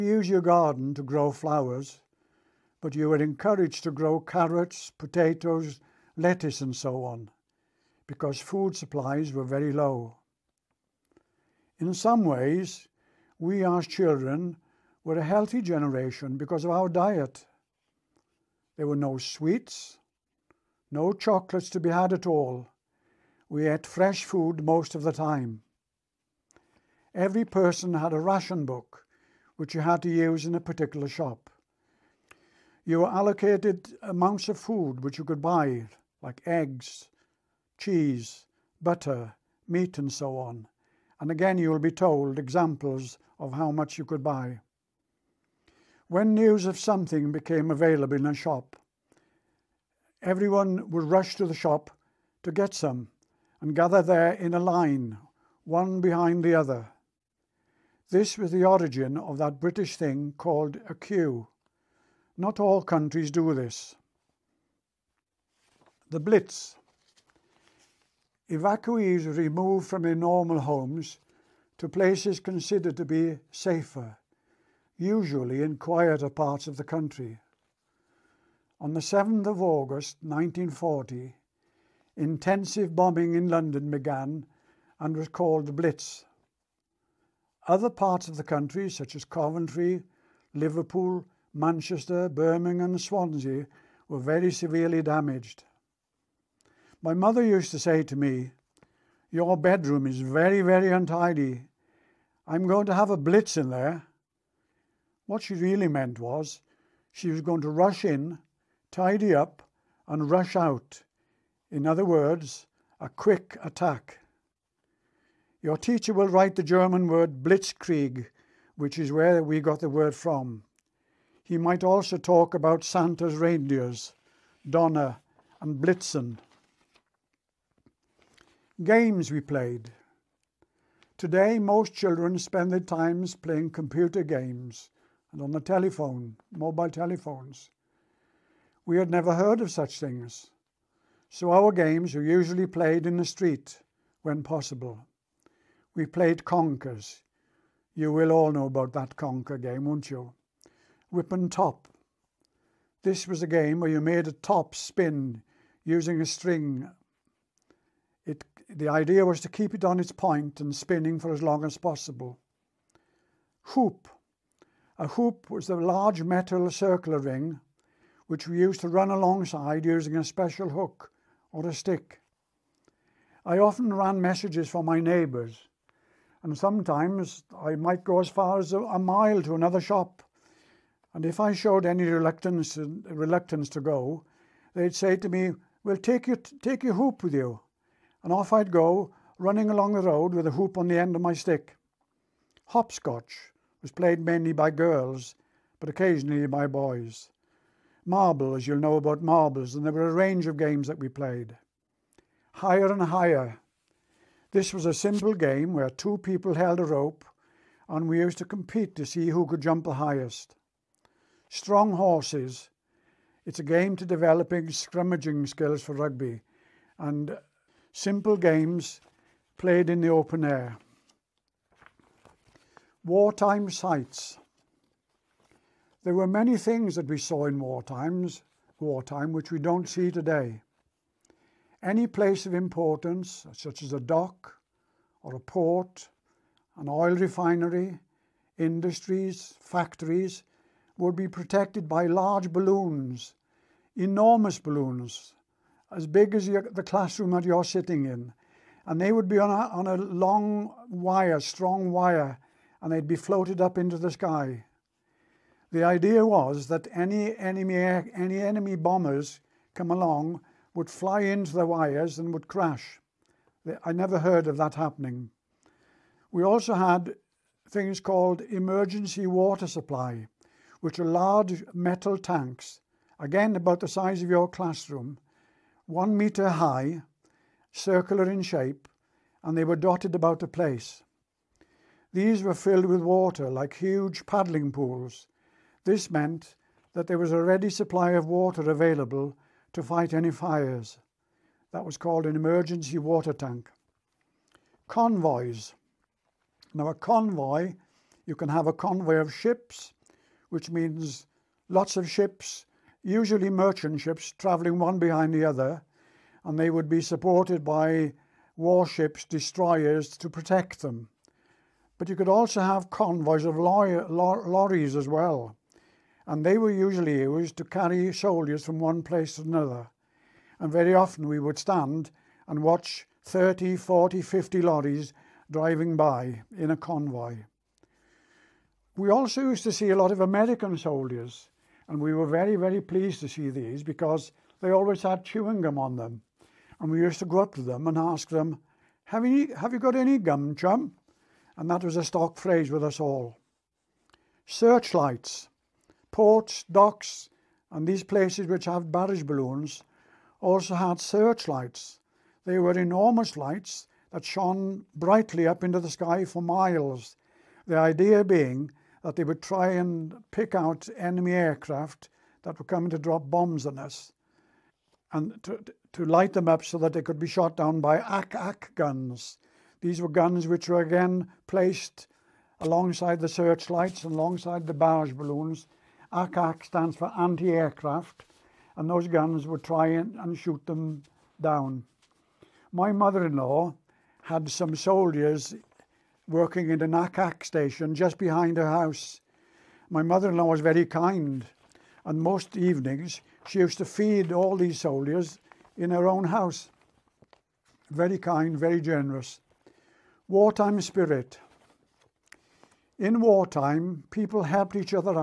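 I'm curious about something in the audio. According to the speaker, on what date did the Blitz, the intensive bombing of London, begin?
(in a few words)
7th of August 1940.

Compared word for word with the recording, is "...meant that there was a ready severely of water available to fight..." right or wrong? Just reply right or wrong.
wrong.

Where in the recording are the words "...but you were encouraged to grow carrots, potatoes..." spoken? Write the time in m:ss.
0:02.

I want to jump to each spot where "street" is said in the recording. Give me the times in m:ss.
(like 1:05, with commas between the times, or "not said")
2:23.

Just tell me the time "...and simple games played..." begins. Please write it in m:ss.
3:36.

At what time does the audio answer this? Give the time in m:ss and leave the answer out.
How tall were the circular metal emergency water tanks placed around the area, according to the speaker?
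4:35.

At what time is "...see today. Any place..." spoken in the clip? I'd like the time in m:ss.
3:49.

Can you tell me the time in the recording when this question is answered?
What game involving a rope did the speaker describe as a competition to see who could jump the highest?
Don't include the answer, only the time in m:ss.
3:22.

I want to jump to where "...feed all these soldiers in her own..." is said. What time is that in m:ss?
6:33.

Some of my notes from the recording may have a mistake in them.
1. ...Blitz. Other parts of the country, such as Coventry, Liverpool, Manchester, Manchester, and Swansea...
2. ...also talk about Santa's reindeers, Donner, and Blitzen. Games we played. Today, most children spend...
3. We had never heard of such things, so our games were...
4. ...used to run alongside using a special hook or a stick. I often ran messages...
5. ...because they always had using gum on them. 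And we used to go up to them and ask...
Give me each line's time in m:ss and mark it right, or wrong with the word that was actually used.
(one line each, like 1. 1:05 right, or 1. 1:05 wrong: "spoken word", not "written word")
1. 1:25 wrong: "Birmingham", not "Manchester"
2. 2:01 right
3. 2:18 right
4. 2:48 right
5. 5:33 wrong: "chewing", not "using".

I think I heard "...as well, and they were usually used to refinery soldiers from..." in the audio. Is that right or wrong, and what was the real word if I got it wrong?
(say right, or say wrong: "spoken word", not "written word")
wrong: "carry", not "refinery".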